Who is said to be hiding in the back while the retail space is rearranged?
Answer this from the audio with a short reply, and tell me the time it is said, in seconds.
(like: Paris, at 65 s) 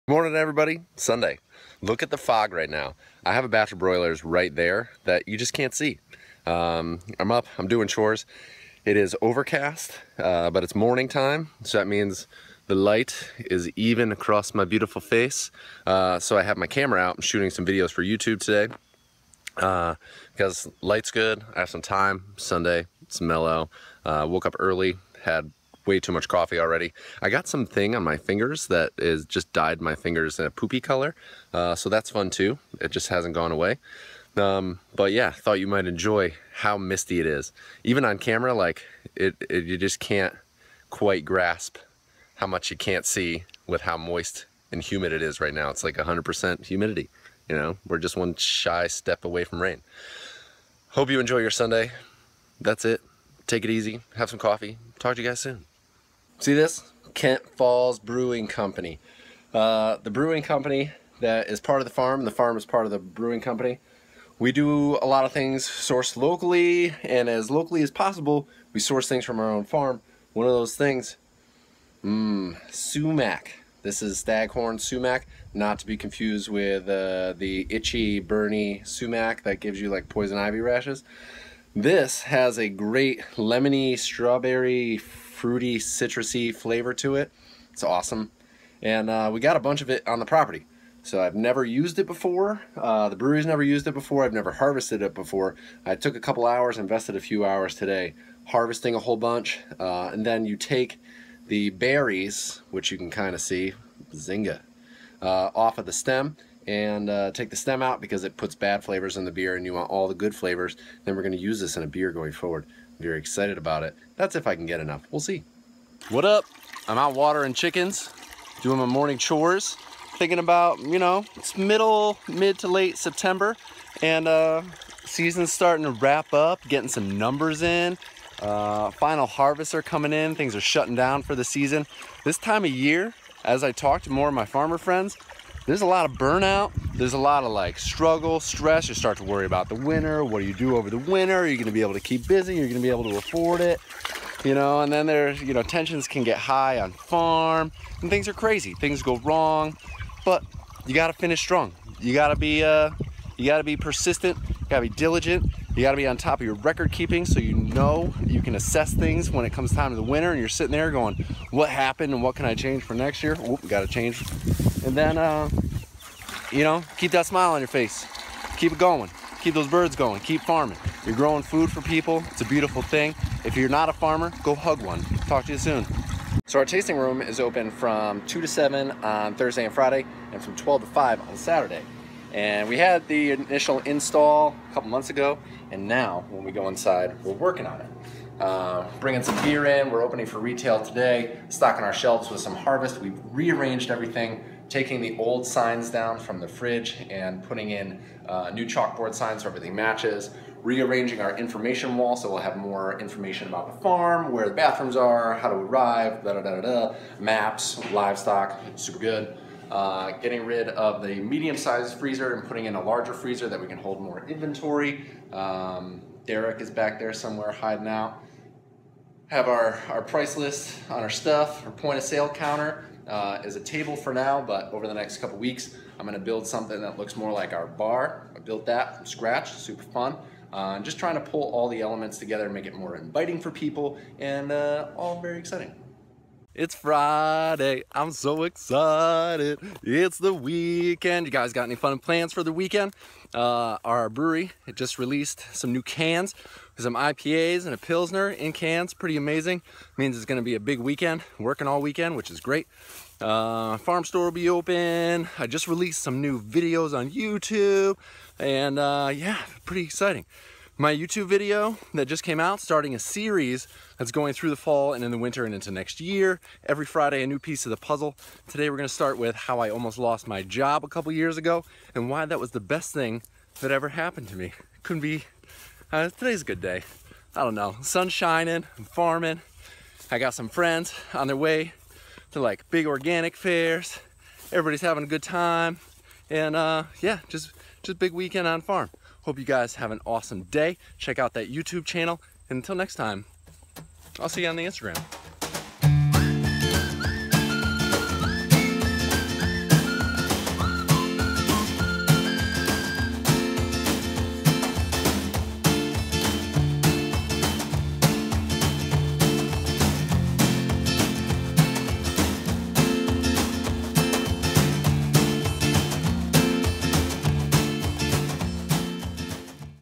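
Derek, at 216 s.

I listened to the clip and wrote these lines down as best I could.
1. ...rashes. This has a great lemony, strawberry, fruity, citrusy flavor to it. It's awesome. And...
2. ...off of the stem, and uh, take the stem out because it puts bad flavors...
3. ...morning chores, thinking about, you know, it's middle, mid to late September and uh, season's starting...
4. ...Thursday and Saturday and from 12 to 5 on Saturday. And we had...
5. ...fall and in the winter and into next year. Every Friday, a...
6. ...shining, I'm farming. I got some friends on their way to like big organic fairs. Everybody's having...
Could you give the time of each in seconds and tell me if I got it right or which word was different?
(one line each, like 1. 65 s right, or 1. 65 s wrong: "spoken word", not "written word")
1. 80 s right
2. 105 s right
3. 118 s right
4. 179 s wrong: "Friday", not "Saturday"
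5. 264 s right
6. 278 s right.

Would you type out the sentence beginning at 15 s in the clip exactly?
Uh, so I have my camera out, I'm shooting some videos for YouTube today.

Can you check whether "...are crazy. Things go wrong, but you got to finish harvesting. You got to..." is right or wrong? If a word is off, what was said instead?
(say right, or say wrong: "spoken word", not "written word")
wrong: "strong", not "harvesting".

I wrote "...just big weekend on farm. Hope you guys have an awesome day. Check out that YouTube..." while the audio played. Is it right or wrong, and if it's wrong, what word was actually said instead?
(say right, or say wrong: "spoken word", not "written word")
right.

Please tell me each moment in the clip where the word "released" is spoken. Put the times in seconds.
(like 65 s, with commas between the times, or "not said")
244 s, 255 s.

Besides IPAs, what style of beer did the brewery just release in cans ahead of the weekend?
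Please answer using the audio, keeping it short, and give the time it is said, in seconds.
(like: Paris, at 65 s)
Pilsner, at 247 s.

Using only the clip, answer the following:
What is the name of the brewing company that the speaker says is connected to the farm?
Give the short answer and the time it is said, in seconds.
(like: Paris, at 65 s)
Kent Falls Brewing Company, at 57 s.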